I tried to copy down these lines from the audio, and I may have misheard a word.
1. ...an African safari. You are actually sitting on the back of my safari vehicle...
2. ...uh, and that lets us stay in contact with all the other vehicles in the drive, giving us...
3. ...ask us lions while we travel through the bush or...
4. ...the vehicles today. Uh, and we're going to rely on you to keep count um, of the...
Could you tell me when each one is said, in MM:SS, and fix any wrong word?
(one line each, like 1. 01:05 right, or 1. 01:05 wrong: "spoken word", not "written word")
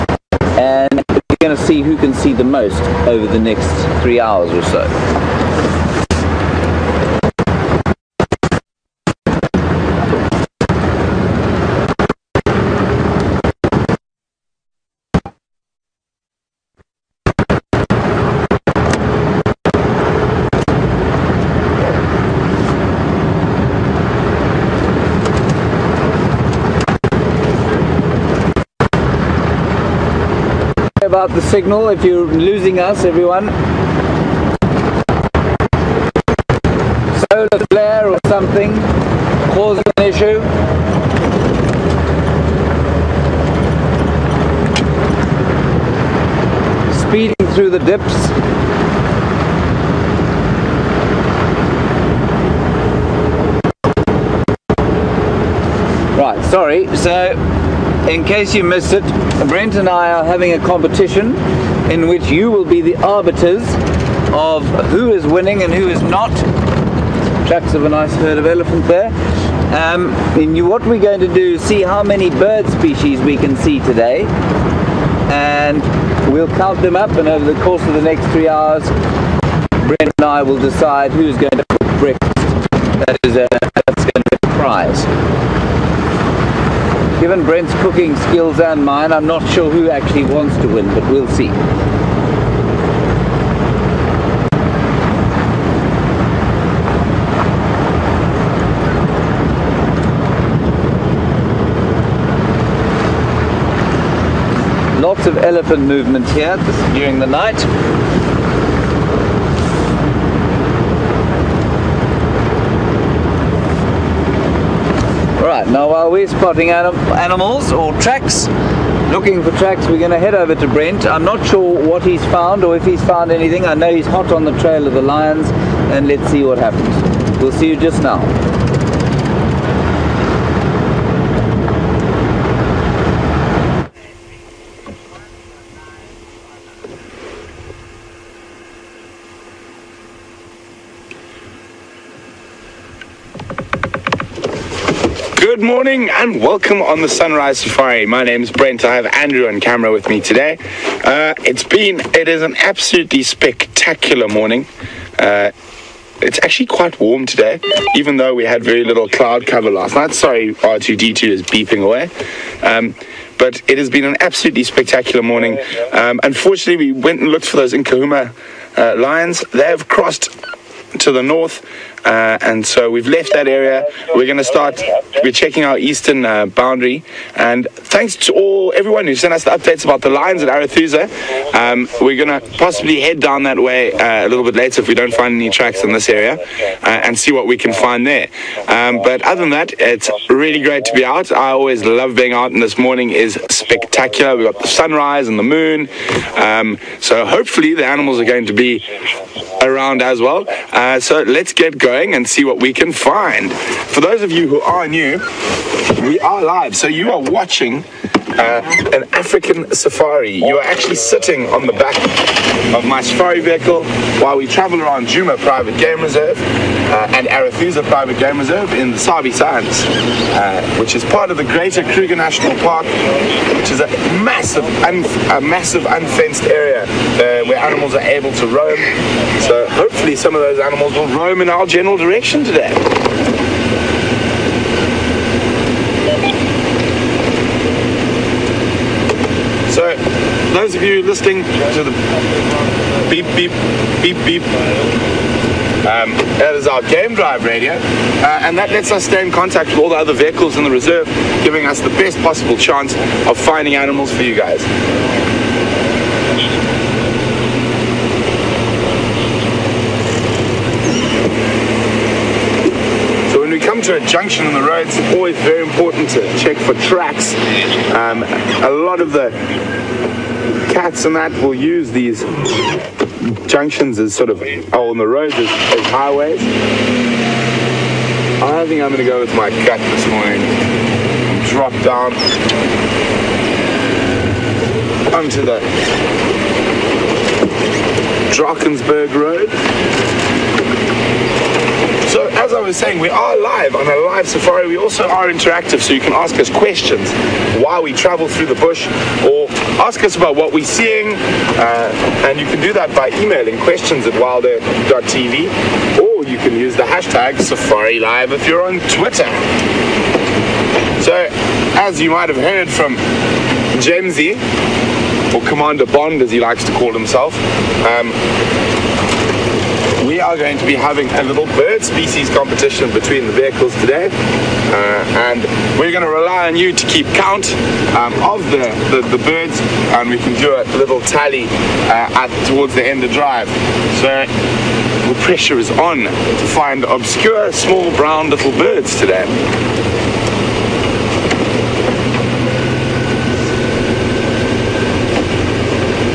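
1. 03:28 right
2. 04:07 wrong: "reserve", not "drive"
3. 04:56 wrong: "questions", not "lions"
4. 05:23 right.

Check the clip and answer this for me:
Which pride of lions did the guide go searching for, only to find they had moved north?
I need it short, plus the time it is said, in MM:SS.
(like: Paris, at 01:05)
Nkuhuma, at 02:47.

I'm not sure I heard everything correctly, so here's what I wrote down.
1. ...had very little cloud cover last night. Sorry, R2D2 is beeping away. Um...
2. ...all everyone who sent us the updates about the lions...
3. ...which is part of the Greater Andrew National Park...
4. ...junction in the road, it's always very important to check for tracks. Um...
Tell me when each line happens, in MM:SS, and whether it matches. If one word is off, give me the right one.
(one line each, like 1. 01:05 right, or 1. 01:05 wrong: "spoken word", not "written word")
1. 02:38 right
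2. 02:58 right
3. 03:40 wrong: "Kruger", not "Andrew"
4. 04:24 right.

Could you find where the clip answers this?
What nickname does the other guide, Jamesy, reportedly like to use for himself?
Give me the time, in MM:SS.
05:15.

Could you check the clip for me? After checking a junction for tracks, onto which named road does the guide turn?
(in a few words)
Drakensberg Road.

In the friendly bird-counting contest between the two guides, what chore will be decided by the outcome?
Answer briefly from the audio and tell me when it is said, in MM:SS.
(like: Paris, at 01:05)
Cook breakfast, at 01:21.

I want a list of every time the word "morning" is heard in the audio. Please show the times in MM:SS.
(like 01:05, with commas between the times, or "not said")
02:25, 02:34, 02:45, 03:12, 04:40.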